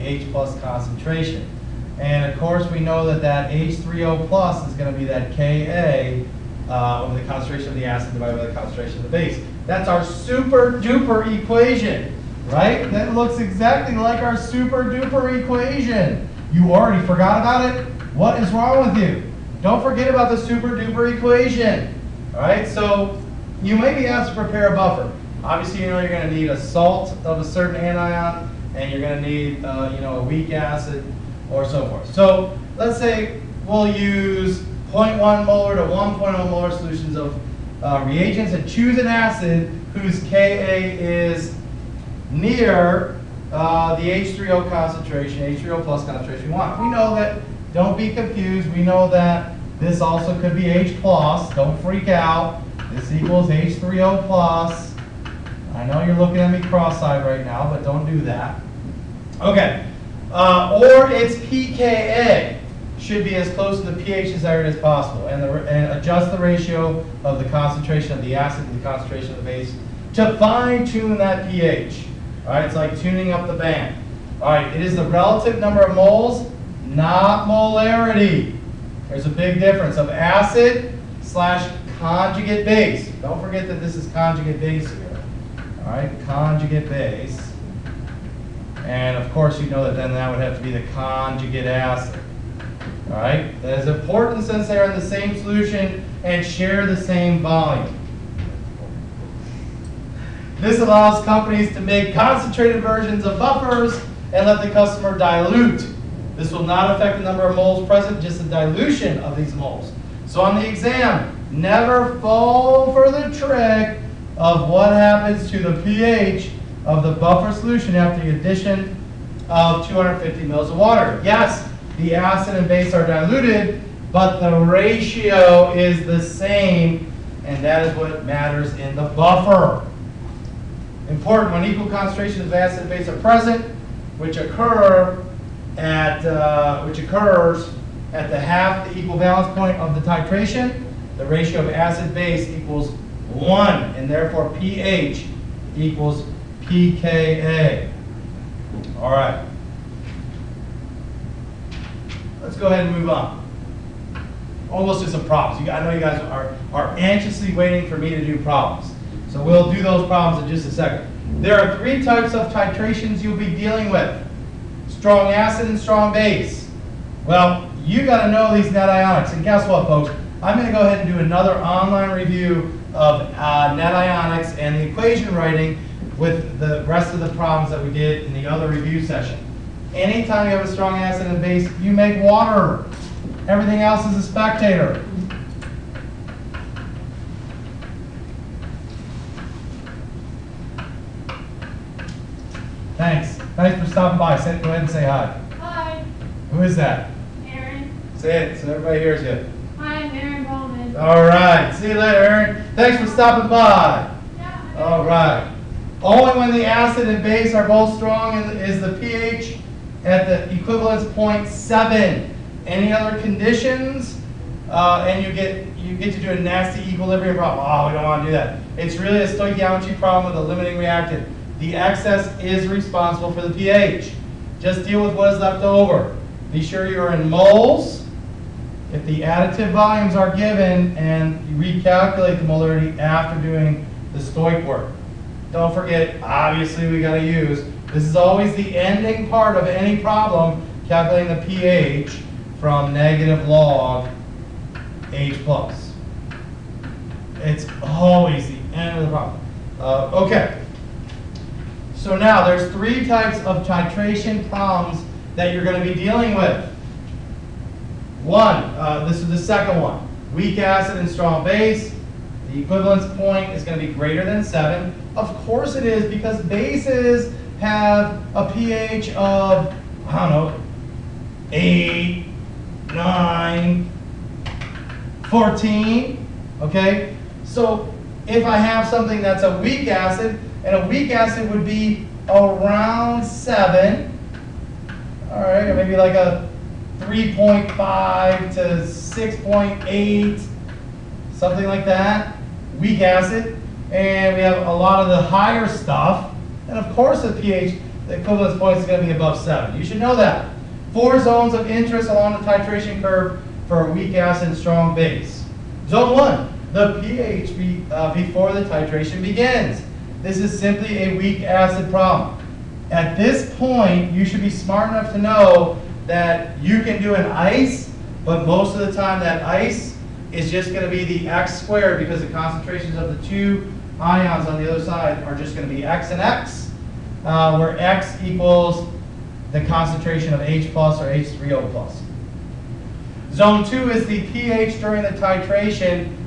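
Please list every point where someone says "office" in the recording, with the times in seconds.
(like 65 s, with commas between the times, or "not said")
not said.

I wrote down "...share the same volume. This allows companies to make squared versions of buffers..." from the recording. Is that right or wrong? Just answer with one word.
wrong.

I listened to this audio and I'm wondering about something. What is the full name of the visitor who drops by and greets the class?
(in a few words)
Aaron Bowman.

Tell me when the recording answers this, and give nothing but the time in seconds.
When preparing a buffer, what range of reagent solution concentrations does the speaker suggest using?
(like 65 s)
34 s.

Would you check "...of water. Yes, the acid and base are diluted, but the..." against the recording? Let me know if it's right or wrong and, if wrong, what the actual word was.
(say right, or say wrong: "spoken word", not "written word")
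right.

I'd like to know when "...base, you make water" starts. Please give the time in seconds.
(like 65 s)
181 s.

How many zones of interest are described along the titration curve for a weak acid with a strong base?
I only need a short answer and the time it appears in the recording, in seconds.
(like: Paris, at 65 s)
4, at 300 s.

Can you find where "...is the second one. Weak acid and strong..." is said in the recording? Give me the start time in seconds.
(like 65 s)
259 s.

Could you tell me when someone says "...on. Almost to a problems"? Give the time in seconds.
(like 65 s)
153 s.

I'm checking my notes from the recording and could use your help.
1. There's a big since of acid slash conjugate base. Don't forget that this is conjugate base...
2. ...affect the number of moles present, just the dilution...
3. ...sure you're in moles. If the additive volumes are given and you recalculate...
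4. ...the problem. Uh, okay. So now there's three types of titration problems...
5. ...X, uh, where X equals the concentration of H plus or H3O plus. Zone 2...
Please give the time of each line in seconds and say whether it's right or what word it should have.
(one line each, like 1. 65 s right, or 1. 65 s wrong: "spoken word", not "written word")
1. 79 s wrong: "difference", not "since"
2. 106 s right
3. 226 s right
4. 249 s right
5. 326 s right.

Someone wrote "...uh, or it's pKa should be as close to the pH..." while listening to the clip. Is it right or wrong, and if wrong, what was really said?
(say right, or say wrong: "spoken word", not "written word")
right.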